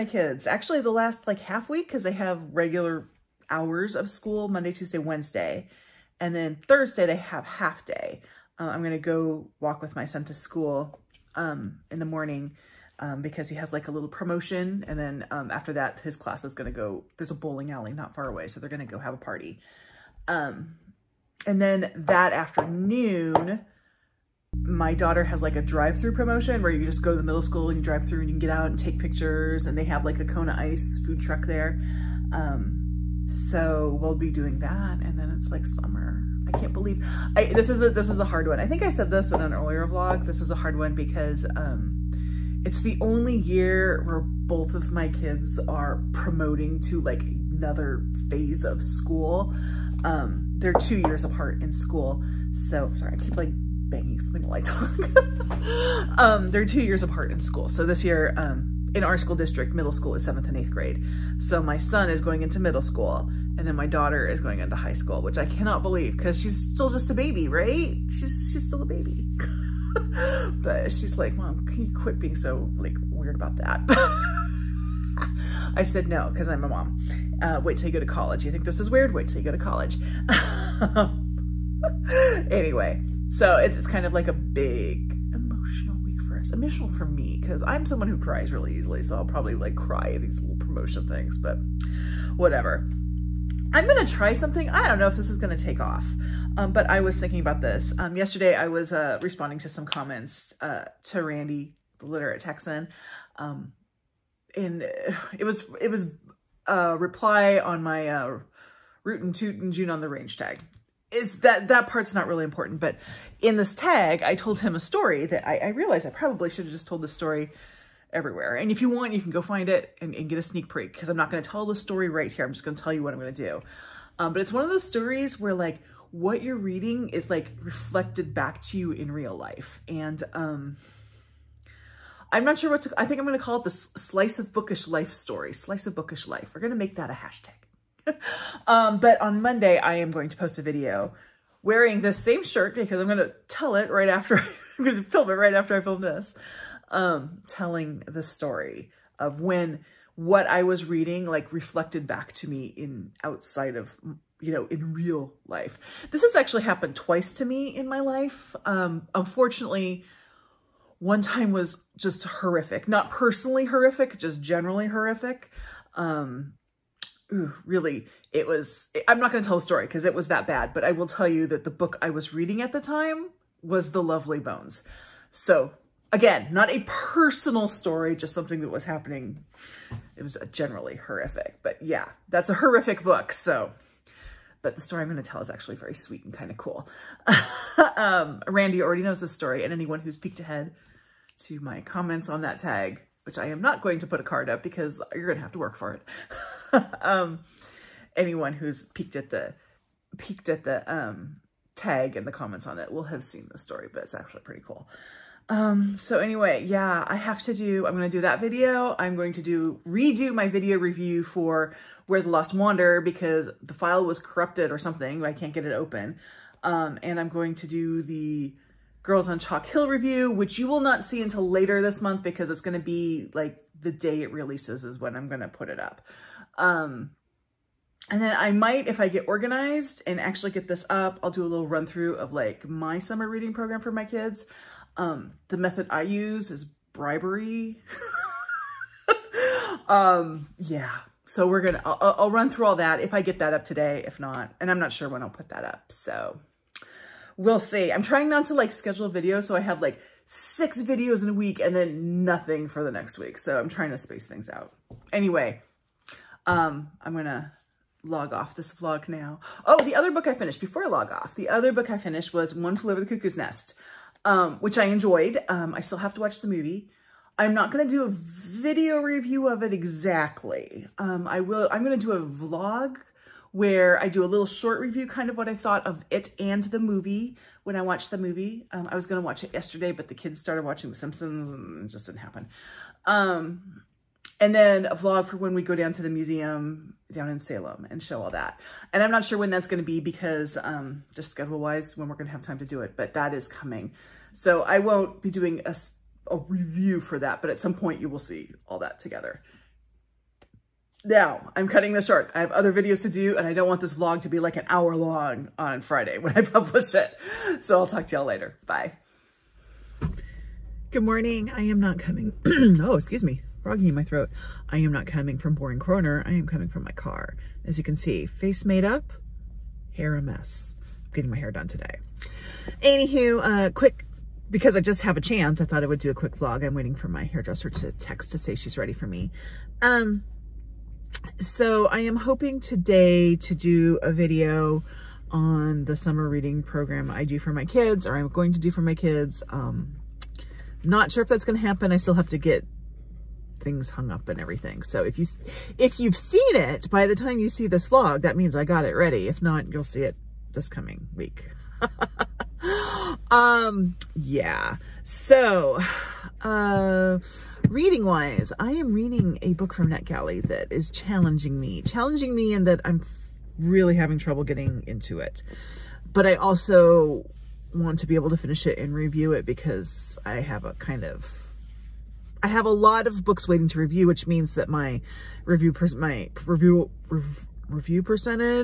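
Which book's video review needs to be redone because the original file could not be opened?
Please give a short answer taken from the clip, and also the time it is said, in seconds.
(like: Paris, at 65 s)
Where the Lost Wander, at 212 s.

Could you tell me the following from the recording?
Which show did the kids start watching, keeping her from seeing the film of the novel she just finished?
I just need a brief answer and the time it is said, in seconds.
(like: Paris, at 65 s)
The Simpsons, at 280 s.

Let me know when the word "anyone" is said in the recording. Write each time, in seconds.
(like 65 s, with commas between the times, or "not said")
189 s, 198 s.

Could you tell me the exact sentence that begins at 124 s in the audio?
Um, but it's one of those stories where like what you're reading is like reflected back to you in real life.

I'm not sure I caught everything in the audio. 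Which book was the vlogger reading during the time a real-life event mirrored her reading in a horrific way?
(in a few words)
The Lovely Bones.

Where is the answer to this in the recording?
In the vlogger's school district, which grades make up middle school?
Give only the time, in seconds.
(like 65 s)
60 s.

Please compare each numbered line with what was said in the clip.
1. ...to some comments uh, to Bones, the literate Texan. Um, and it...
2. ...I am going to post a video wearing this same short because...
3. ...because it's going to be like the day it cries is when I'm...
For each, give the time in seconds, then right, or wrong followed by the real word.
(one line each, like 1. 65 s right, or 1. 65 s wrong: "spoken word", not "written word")
1. 99 s wrong: "Randy", not "Bones"
2. 139 s wrong: "shirt", not "short"
3. 222 s wrong: "releases", not "cries".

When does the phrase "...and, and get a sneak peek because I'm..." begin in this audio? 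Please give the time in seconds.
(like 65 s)
120 s.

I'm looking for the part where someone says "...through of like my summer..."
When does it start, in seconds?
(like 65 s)
231 s.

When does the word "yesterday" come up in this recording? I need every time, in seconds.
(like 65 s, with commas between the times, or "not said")
98 s, 279 s.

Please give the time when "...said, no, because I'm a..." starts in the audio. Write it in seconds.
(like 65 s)
75 s.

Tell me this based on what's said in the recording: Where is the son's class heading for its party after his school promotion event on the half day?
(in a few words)
Bowling alley.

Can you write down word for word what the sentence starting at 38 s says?
I think I said this in an earlier vlog.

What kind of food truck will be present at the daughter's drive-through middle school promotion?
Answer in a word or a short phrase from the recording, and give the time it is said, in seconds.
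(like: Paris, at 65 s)
Kona Ice, at 30 s.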